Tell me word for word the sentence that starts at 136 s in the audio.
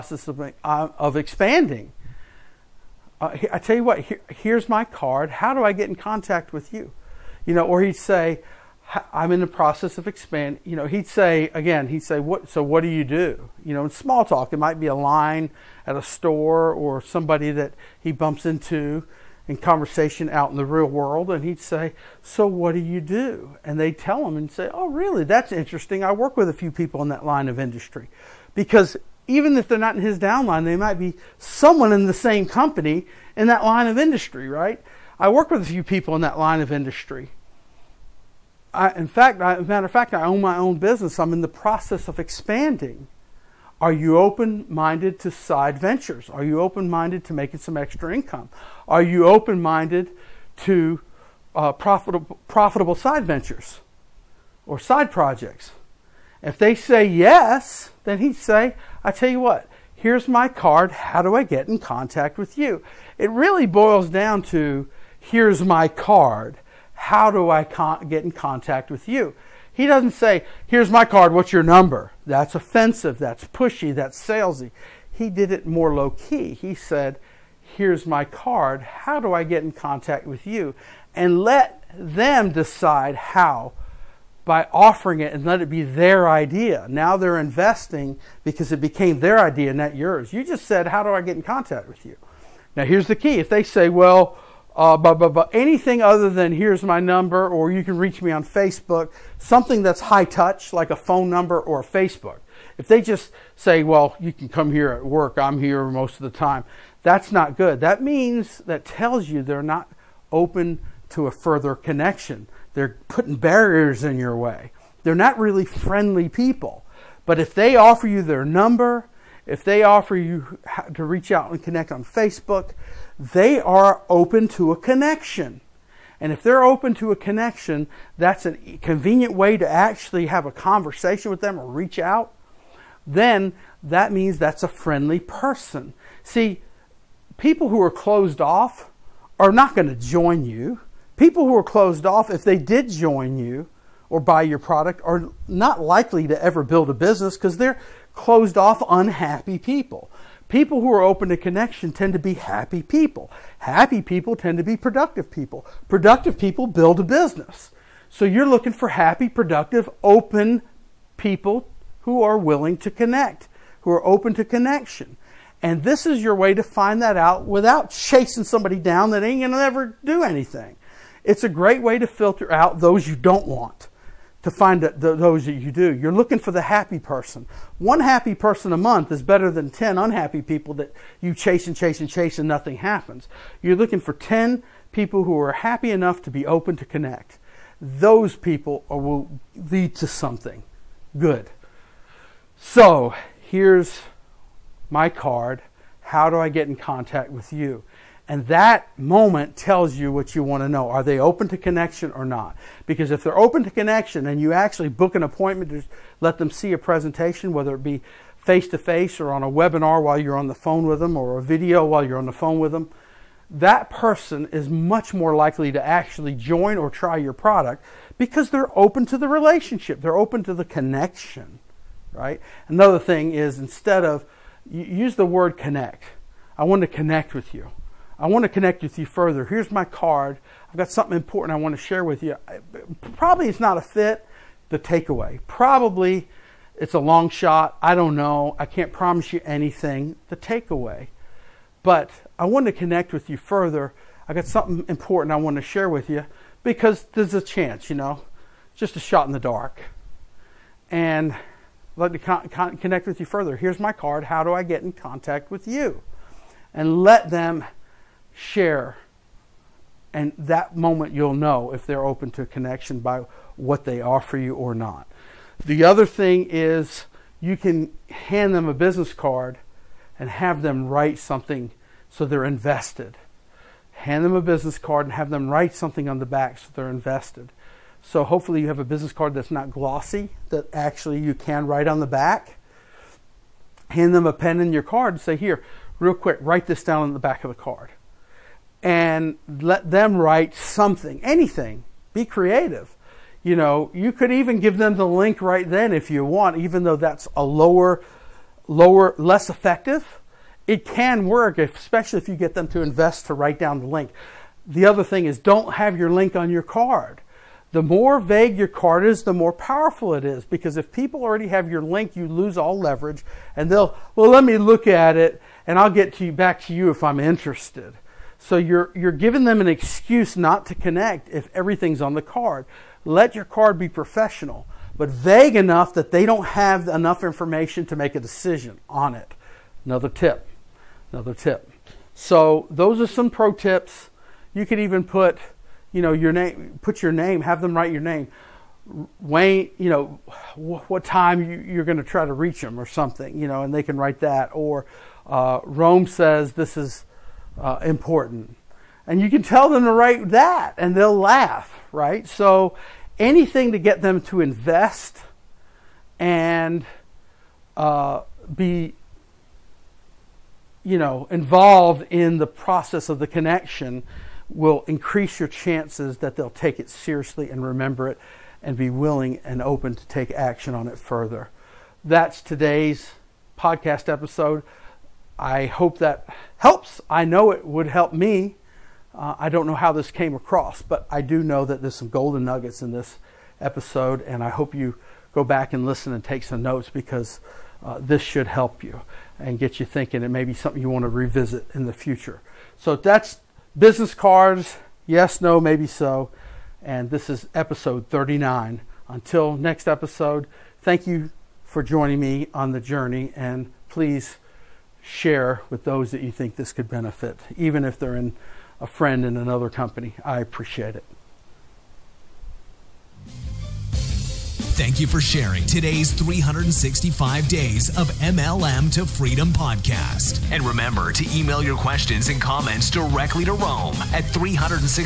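See, people who are closed off are not going to join you.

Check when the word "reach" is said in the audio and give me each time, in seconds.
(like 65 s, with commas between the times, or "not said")
97 s, 121 s, 131 s, 342 s.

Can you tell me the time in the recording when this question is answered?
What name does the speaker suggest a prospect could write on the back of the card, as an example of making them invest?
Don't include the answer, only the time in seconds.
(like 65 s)
339 s.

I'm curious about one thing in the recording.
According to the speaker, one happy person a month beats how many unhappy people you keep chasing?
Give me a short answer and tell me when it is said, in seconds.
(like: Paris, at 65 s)
10, at 179 s.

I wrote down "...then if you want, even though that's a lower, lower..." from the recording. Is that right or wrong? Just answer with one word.
right.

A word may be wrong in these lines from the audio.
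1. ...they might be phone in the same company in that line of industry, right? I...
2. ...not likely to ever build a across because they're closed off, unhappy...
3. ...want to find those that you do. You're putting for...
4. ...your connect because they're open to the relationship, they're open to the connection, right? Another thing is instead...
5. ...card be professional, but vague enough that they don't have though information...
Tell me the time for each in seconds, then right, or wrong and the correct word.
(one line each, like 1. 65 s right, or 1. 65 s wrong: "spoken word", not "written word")
1. 30 s wrong: "someone", not "phone"
2. 145 s wrong: "business", not "across"
3. 173 s wrong: "looking", not "putting"
4. 217 s wrong: "product", not "connect"
5. 323 s wrong: "enough", not "though".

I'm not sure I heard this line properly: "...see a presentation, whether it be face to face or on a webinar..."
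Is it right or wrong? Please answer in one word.
right.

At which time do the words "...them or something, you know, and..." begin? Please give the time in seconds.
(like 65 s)
342 s.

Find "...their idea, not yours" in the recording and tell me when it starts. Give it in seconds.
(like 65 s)
89 s.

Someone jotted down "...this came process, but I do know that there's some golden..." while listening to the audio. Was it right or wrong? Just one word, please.
wrong.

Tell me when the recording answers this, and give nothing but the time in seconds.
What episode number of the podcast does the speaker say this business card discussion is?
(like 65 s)
397 s.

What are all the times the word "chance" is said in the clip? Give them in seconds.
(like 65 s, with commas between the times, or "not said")
247 s, 365 s.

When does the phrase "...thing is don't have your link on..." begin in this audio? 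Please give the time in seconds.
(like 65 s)
305 s.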